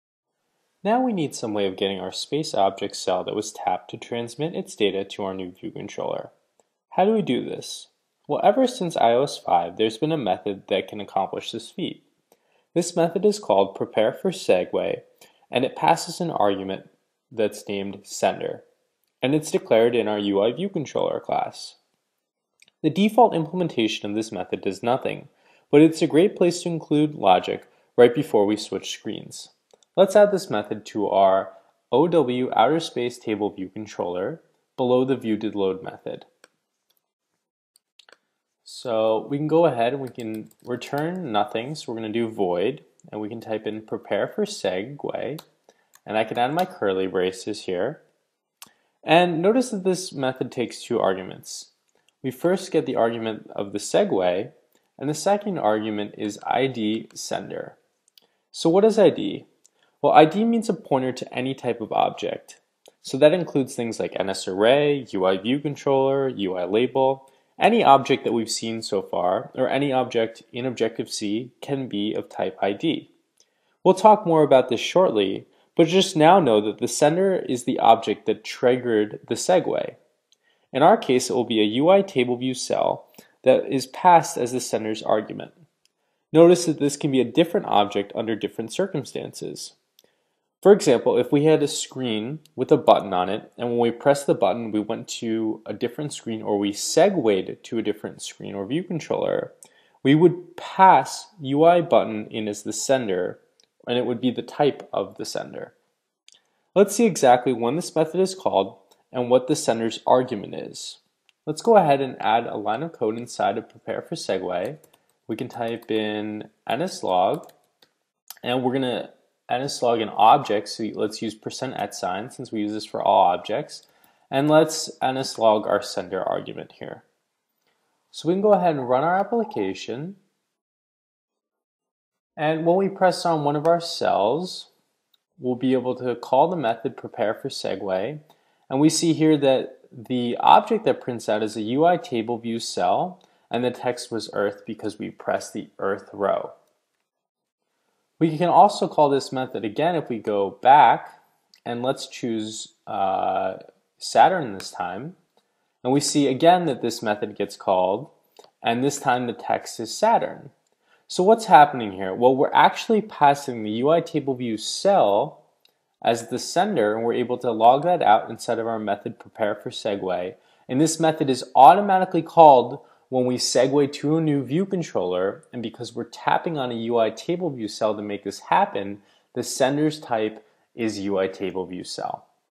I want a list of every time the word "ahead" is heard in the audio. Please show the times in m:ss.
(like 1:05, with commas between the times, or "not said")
0:39, 1:51, 2:08.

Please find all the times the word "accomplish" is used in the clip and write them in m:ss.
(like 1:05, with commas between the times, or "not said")
0:10.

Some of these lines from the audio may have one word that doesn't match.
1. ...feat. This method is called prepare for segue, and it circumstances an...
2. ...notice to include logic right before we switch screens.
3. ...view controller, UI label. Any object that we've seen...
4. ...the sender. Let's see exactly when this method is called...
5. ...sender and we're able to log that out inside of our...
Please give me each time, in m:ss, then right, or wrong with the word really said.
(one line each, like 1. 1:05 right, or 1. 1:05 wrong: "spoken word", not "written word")
1. 0:11 wrong: "passes", not "circumstances"
2. 0:26 wrong: "place", not "notice"
3. 1:05 right
4. 1:45 right
5. 2:46 right.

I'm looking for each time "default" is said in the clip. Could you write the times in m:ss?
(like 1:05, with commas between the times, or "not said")
0:22.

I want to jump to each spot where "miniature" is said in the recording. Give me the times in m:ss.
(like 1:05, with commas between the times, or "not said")
not said.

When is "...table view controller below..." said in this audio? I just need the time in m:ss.
0:33.